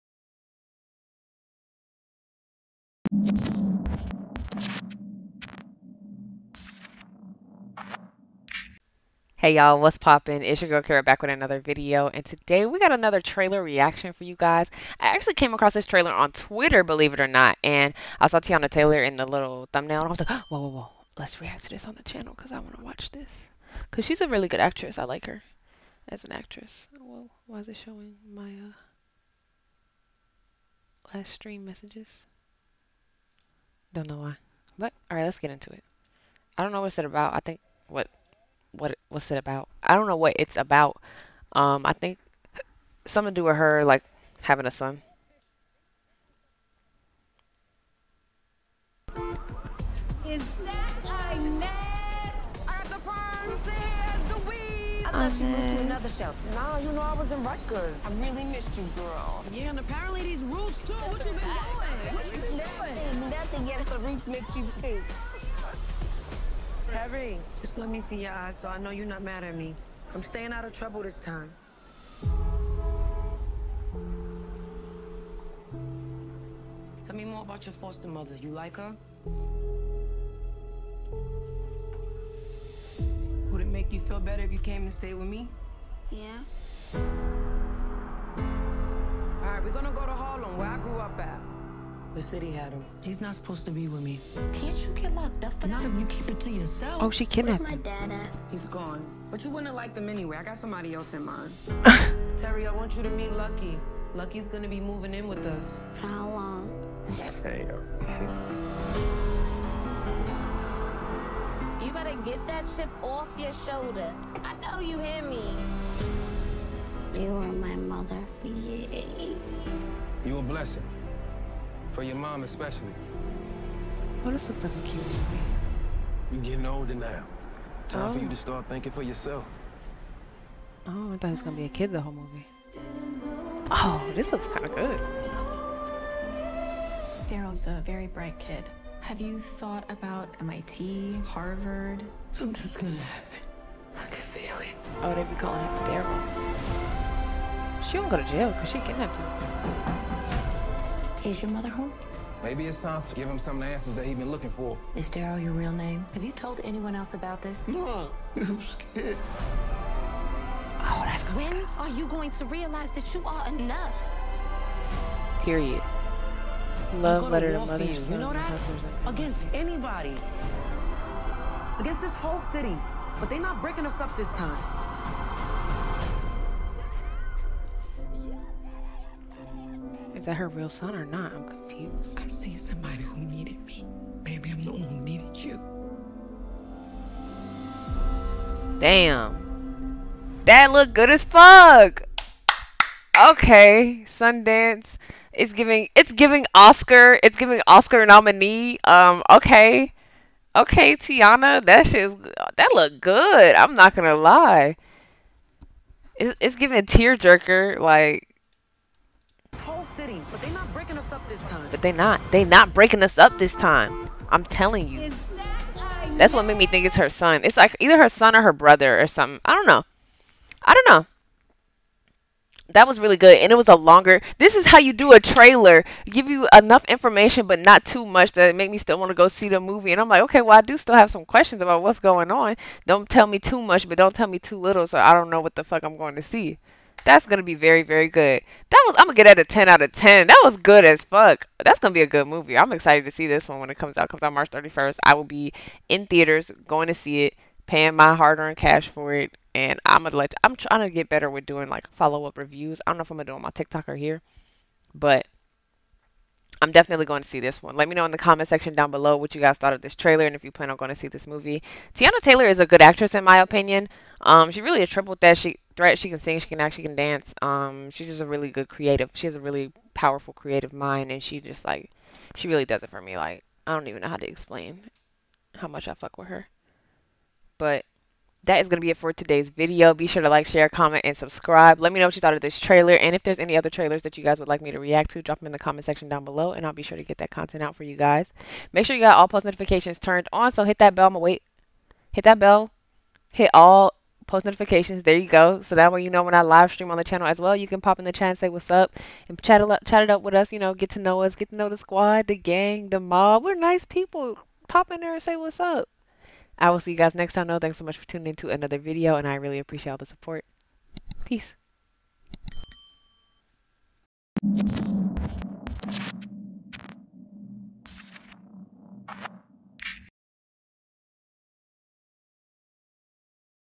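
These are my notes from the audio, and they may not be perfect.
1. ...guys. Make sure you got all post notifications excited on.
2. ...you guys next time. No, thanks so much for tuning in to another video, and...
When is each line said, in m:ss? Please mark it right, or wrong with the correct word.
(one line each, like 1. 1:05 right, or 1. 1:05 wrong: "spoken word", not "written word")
1. 4:47 wrong: "turned", not "excited"
2. 5:06 right.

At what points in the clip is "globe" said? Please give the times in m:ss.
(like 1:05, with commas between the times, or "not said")
not said.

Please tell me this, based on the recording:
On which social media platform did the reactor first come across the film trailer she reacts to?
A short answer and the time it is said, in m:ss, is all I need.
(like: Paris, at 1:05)
Twitter, at 0:16.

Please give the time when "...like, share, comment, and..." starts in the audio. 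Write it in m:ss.
4:40.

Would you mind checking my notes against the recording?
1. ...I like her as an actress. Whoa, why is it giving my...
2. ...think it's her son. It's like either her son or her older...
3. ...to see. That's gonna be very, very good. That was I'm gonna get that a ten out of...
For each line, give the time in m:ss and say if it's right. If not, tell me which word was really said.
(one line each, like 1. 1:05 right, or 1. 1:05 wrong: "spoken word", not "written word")
1. 0:24 wrong: "showing", not "giving"
2. 3:36 wrong: "brother", not "older"
3. 3:56 right.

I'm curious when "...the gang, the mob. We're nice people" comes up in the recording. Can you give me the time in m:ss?
5:02.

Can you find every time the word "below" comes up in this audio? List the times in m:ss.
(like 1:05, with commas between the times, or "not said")
4:18, 4:46.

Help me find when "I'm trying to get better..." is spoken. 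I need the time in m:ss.
4:10.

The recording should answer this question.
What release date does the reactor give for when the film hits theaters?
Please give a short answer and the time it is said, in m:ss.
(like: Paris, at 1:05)
March 31st, at 4:04.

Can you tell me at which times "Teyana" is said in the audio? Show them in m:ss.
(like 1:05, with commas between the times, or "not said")
0:18, 3:20, 4:21.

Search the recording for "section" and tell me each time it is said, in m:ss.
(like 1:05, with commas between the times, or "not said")
4:18, 4:45.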